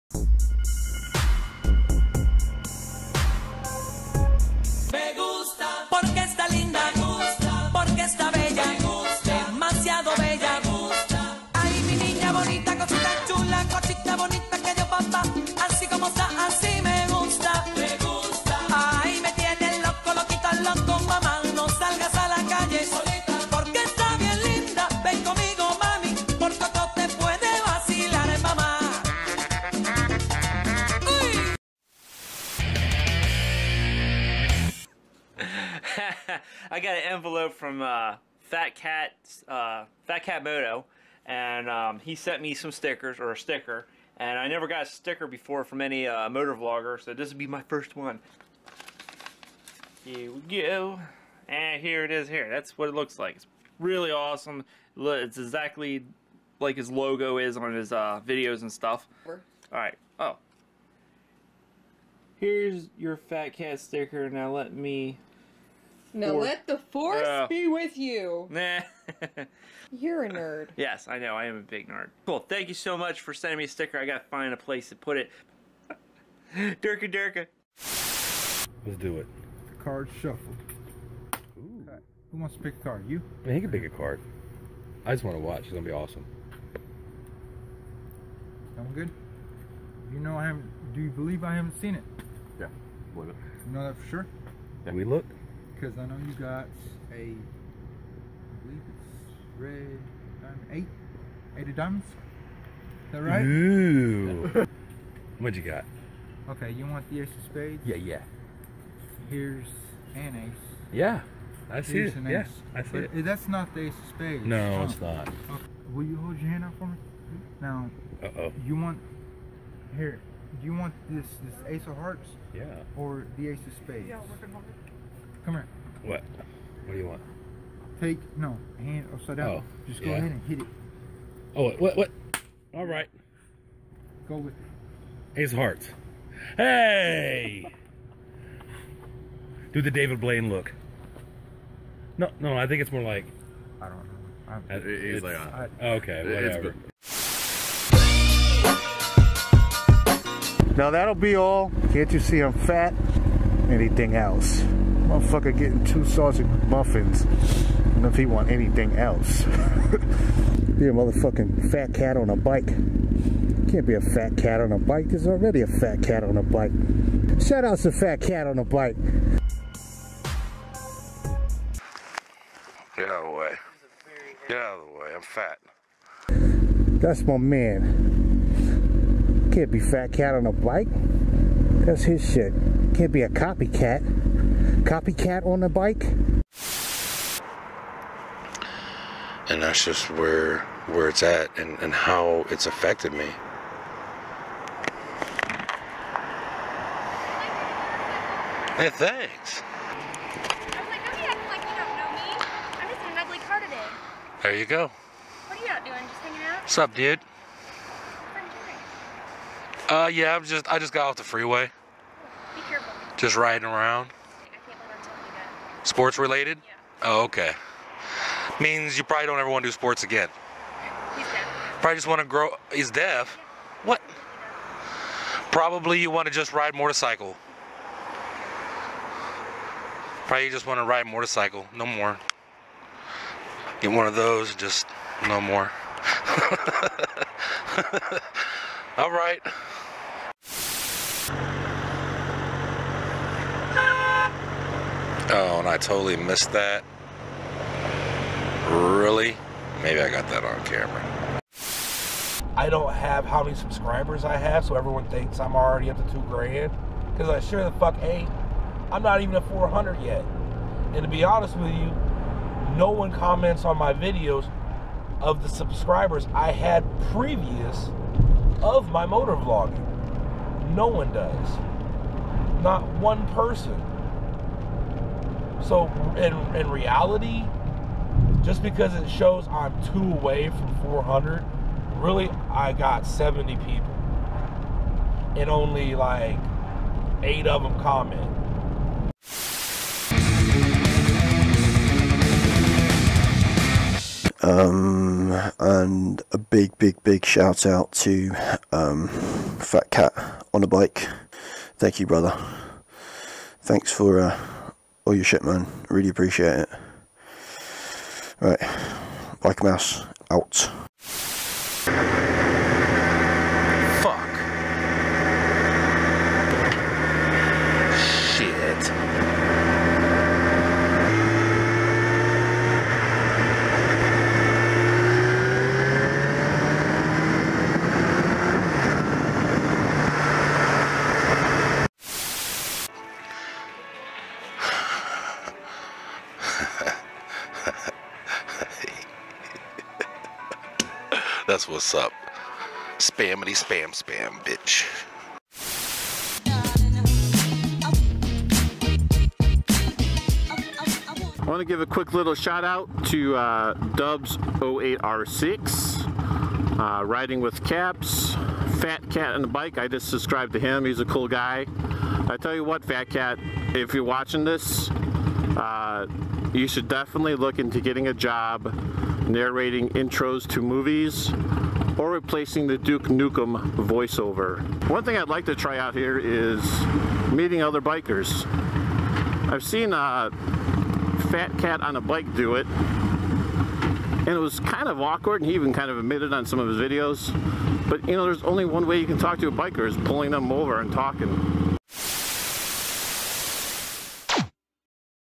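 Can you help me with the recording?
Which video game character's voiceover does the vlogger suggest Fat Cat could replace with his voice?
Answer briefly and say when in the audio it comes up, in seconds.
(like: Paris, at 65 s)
Duke Nukem, at 372 s.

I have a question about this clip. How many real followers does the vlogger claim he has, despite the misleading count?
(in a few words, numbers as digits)
70.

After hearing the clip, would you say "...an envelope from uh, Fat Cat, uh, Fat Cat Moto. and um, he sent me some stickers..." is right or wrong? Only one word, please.
right.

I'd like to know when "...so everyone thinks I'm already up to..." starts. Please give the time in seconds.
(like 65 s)
254 s.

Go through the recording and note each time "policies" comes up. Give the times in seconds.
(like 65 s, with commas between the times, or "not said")
not said.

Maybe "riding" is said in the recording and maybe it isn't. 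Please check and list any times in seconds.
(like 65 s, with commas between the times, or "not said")
213 s, 357 s.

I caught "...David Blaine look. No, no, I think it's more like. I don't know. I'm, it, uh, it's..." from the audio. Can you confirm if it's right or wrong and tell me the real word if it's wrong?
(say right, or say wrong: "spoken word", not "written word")
right.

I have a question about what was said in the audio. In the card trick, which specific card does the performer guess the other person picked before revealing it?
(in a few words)
eight of diamonds.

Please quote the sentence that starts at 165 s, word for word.
There's already a fat cat on a bike.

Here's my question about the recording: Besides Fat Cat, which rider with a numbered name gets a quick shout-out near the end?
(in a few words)
Dubs 08R6.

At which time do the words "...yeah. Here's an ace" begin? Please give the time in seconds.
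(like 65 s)
107 s.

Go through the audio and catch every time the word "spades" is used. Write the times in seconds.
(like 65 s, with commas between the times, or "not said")
107 s, 114 s, 123 s.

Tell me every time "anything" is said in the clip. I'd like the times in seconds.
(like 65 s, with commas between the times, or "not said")
153 s, 158 s.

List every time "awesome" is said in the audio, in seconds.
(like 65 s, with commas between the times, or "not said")
54 s, 85 s.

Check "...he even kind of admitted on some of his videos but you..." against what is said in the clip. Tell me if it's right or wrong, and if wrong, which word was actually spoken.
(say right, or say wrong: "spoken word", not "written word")
right.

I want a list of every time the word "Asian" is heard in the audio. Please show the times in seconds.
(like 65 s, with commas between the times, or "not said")
not said.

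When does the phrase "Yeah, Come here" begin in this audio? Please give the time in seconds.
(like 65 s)
124 s.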